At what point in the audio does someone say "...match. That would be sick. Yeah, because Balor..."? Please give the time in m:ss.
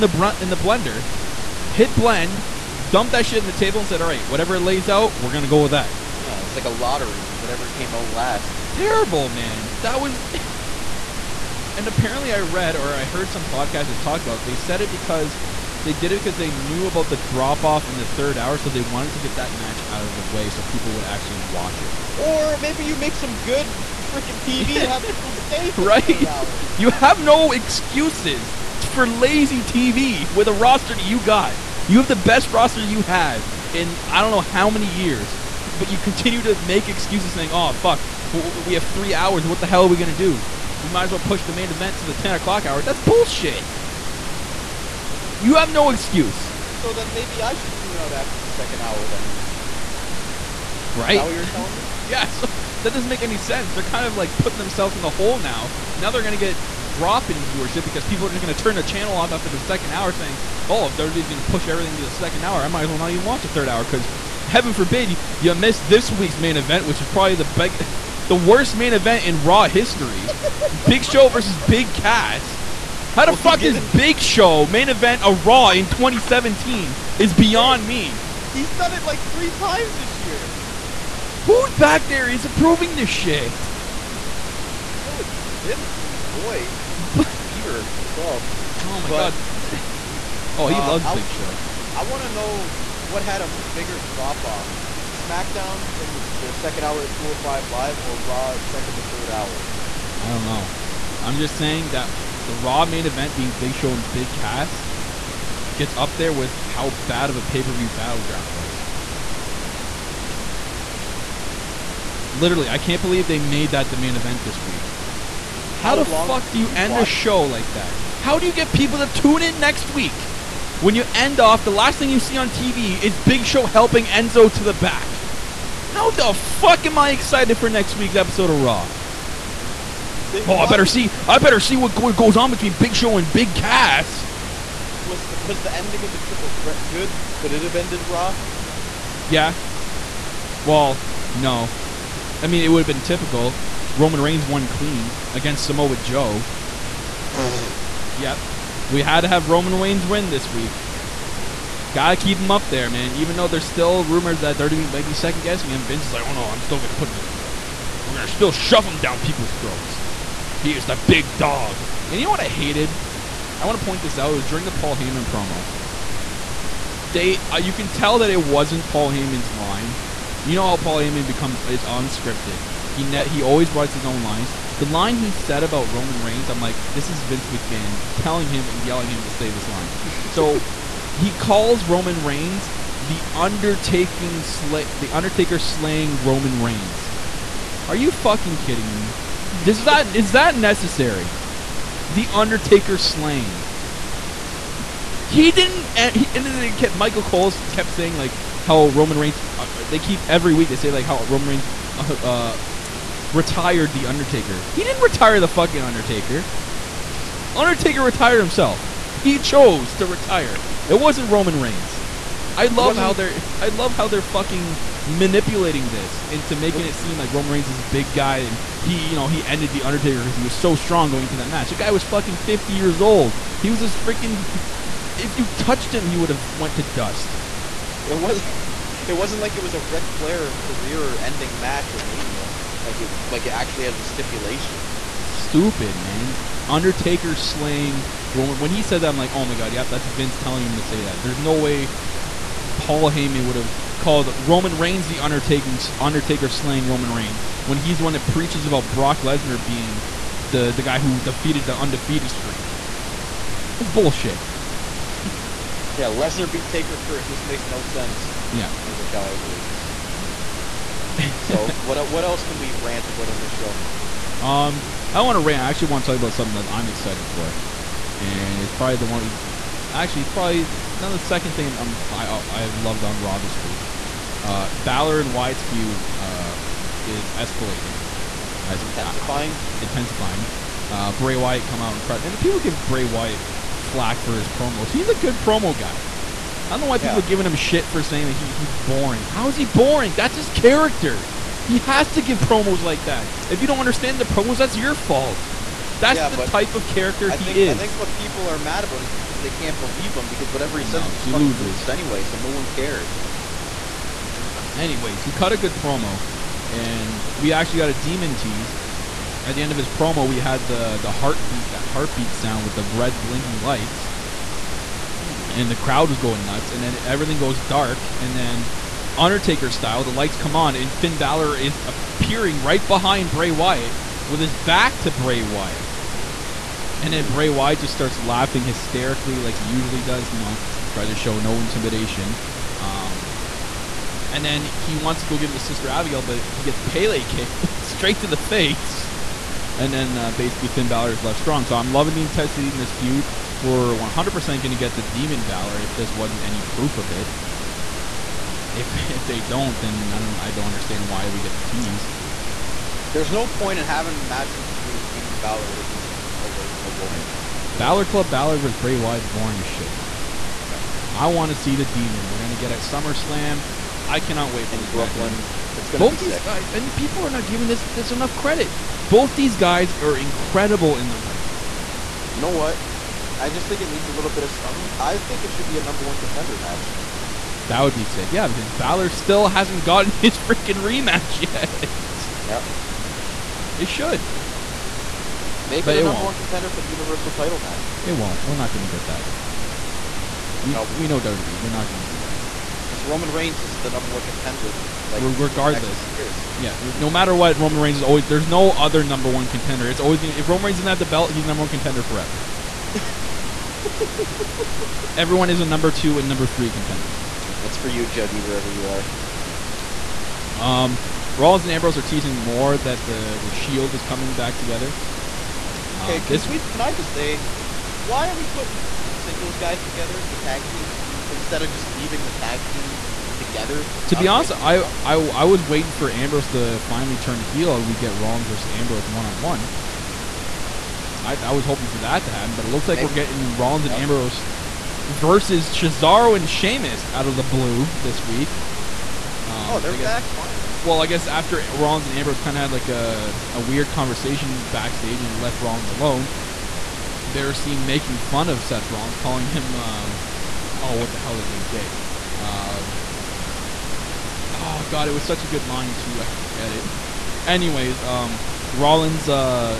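6:16.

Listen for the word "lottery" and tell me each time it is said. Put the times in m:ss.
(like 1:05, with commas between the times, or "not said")
0:06.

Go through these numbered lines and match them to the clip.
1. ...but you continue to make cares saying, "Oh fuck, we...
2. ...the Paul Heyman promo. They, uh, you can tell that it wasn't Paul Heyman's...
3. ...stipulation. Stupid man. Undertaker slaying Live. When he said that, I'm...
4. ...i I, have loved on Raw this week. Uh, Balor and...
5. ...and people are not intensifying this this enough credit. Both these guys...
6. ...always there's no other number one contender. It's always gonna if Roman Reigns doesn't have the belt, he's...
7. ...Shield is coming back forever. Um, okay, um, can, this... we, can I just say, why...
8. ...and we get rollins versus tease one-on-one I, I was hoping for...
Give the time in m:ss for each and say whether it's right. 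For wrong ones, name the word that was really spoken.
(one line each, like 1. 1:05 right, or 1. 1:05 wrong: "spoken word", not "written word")
1. 0:35 wrong: "excuses", not "cares"
2. 2:44 right
3. 3:54 wrong: "Roman", not "Live"
4. 4:32 right
5. 6:06 wrong: "giving", not "intensifying"
6. 6:38 right
7. 6:53 wrong: "together", not "forever"
8. 7:07 wrong: "ambrose", not "tease".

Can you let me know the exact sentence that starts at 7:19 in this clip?
Um, oh, they're guess, back finally.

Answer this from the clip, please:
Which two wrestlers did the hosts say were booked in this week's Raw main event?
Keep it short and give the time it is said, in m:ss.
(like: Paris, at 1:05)
Big Show versus Big Cass, at 1:10.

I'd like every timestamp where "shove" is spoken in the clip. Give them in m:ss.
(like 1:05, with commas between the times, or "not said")
2:38.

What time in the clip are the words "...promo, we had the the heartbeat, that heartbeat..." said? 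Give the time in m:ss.
5:09.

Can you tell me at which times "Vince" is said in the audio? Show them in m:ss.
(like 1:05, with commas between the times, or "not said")
1:25, 2:35, 2:57, 4:00.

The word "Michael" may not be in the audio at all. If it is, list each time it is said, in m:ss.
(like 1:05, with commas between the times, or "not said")
3:16, 4:18.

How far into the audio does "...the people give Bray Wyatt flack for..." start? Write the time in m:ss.
4:42.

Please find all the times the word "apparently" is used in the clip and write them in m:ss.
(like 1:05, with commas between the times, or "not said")
0:11.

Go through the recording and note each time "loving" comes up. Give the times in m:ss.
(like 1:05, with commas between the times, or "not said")
5:41.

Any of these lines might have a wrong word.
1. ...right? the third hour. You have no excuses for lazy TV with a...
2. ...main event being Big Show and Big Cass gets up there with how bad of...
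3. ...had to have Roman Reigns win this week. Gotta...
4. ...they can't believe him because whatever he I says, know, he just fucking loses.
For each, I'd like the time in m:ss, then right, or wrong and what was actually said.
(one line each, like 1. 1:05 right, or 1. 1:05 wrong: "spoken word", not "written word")
1. 0:25 right
2. 1:42 right
3. 2:29 right
4. 4:59 right.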